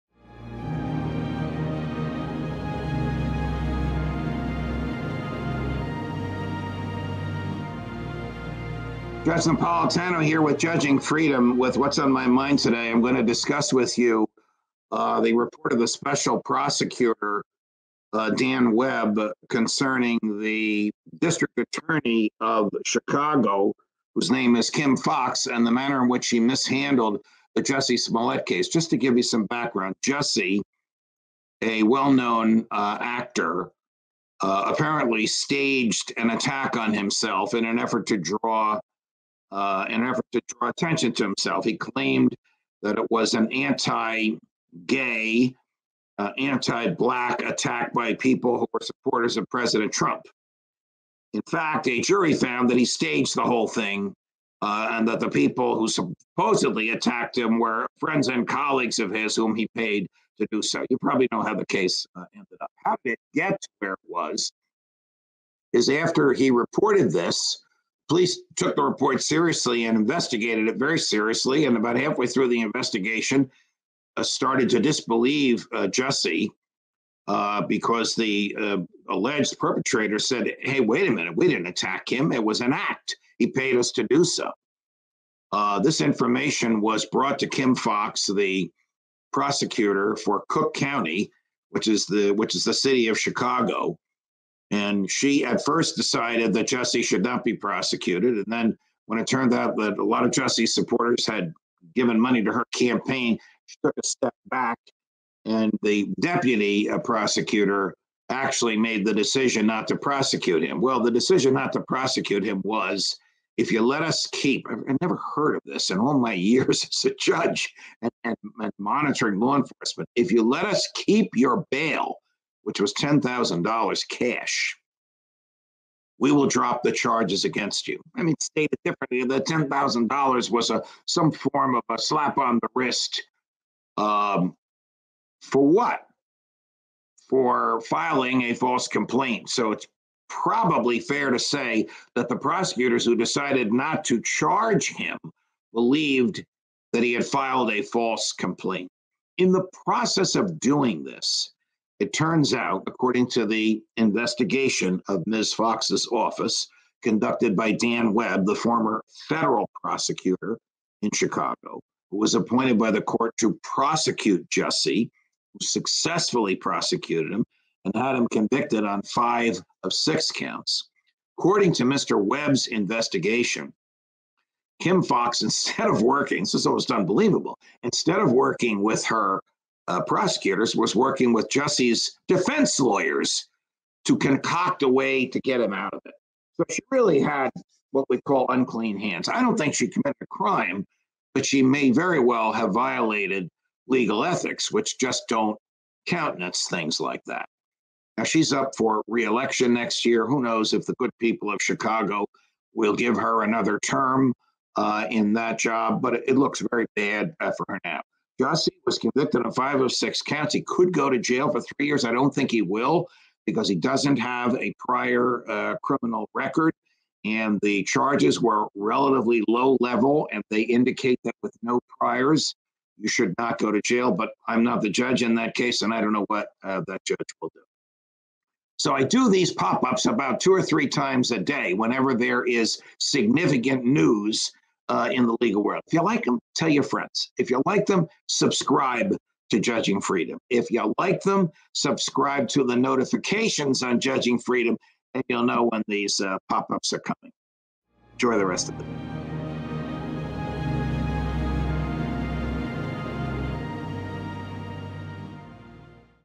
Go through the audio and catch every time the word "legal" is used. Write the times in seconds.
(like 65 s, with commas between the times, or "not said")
193 s, 235 s.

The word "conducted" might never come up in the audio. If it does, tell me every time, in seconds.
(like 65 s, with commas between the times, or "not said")
157 s.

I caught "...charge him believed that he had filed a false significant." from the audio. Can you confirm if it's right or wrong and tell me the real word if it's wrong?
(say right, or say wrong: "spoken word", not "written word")
wrong: "complaint", not "significant".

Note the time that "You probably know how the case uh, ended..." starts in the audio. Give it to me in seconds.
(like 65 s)
60 s.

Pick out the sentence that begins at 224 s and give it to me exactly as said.
But I'm not the judge in that case, and I don't know what uh, that judge will do.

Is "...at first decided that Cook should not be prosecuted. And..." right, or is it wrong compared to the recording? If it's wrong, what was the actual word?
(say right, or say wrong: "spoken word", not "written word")
wrong: "Jussie", not "Cook".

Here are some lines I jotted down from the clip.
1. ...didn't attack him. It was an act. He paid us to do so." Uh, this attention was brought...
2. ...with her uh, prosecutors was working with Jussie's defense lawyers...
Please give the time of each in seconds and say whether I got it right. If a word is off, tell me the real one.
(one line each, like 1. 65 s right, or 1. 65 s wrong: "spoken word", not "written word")
1. 81 s wrong: "information", not "attention"
2. 178 s right.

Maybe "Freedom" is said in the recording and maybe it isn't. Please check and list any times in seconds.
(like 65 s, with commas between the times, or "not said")
10 s, 240 s, 244 s.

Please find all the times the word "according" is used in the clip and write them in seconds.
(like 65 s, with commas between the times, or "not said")
152 s, 171 s.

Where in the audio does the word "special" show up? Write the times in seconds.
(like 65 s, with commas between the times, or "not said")
15 s.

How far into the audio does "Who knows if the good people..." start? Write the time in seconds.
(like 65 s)
200 s.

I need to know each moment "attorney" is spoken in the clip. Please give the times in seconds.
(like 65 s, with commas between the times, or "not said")
21 s.